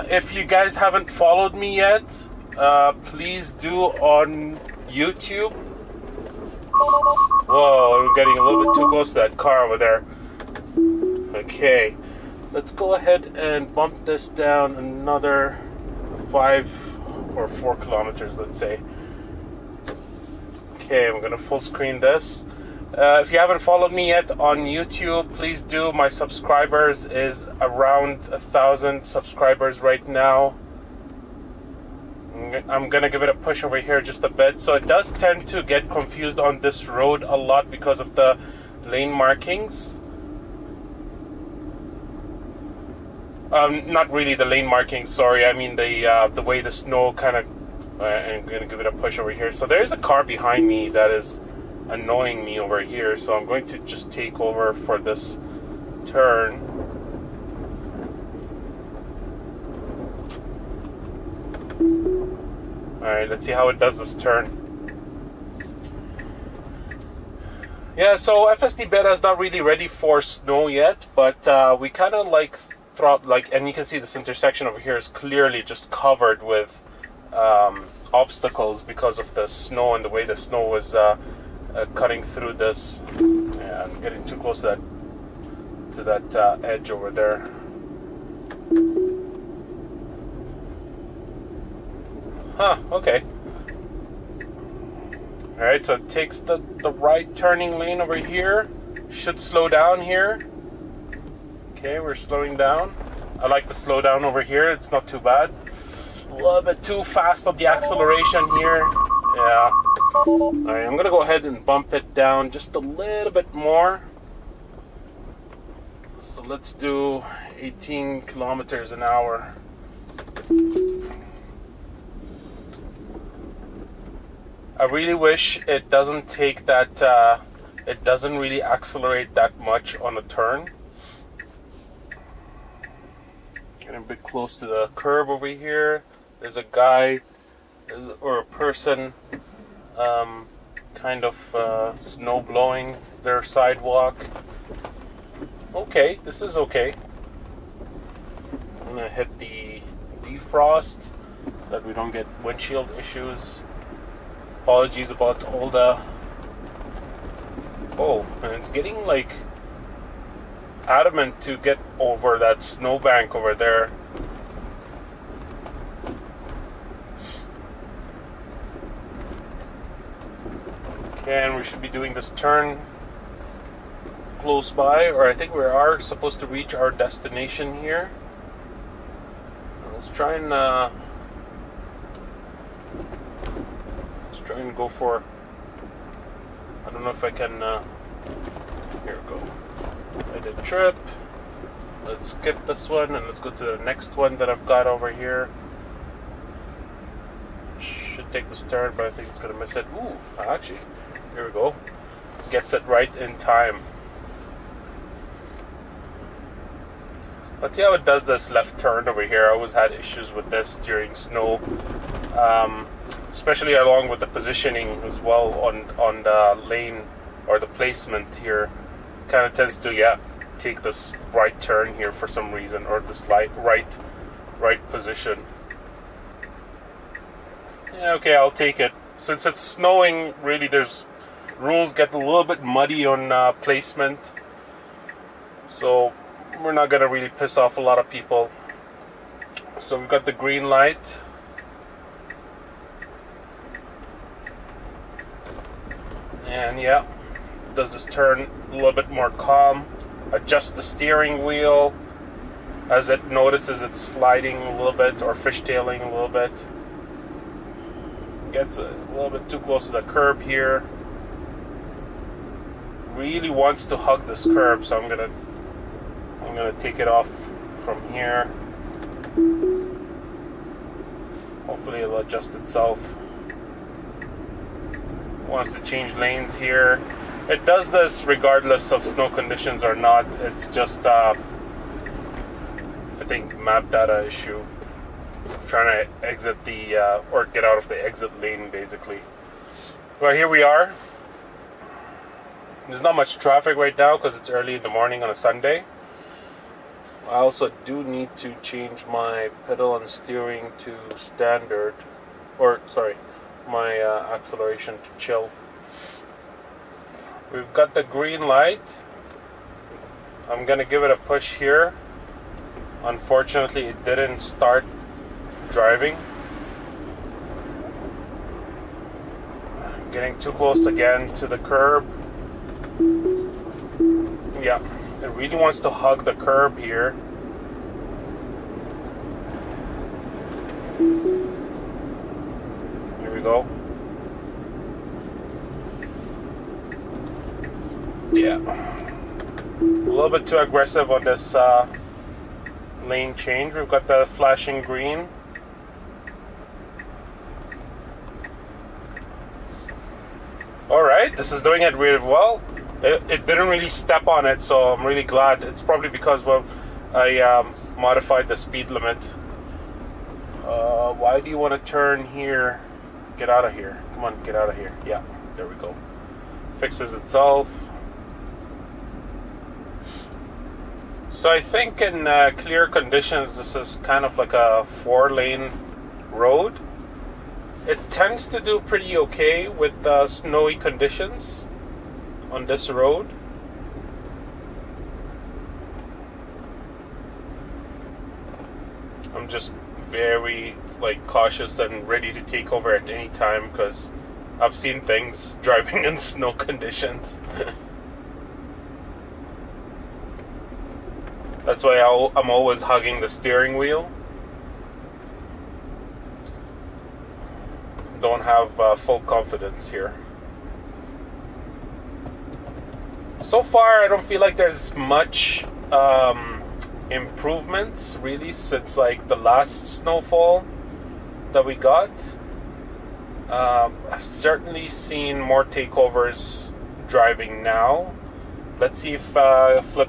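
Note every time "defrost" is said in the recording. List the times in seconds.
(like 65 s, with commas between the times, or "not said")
150 s.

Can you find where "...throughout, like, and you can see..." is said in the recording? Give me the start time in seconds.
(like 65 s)
72 s.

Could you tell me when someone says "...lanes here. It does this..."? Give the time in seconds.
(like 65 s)
276 s.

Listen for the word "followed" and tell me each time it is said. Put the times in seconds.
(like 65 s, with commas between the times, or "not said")
1 s, 23 s.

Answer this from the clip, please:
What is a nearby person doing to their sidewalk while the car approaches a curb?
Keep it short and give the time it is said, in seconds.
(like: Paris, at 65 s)
snow blowing, at 141 s.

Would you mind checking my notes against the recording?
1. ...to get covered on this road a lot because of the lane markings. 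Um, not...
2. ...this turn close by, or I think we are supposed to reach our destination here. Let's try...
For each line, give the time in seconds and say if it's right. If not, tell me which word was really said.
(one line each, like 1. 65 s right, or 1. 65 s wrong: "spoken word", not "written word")
1. 35 s wrong: "confused", not "covered"
2. 172 s right.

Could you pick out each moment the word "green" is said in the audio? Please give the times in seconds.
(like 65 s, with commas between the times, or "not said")
240 s, 308 s, 344 s.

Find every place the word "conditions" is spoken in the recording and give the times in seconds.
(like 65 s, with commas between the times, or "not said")
279 s, 372 s, 380 s, 396 s.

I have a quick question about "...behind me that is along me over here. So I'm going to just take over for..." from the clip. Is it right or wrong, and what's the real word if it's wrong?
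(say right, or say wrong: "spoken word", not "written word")
wrong: "annoying", not "along".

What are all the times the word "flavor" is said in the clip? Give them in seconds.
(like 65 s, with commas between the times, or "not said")
not said.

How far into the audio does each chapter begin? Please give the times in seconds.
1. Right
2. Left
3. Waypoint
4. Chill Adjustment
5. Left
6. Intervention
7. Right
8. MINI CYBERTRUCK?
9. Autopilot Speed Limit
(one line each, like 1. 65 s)
1. 191 s
2. 209 s
3. 161 s
4. 301 s
5. 101 s
6. 311 s
7. 51 s
8. 121 s
9. 11 s.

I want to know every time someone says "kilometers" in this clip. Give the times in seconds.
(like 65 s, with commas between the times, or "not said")
17 s, 118 s.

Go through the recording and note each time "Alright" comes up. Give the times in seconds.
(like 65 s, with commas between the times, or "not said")
63 s, 95 s, 110 s, 350 s.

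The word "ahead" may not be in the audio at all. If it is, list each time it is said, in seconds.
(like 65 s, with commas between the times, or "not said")
12 s, 111 s.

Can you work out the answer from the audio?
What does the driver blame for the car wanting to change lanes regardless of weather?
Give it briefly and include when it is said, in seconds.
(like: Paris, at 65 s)
map data issue, at 283 s.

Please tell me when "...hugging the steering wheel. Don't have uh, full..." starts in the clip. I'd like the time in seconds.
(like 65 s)
402 s.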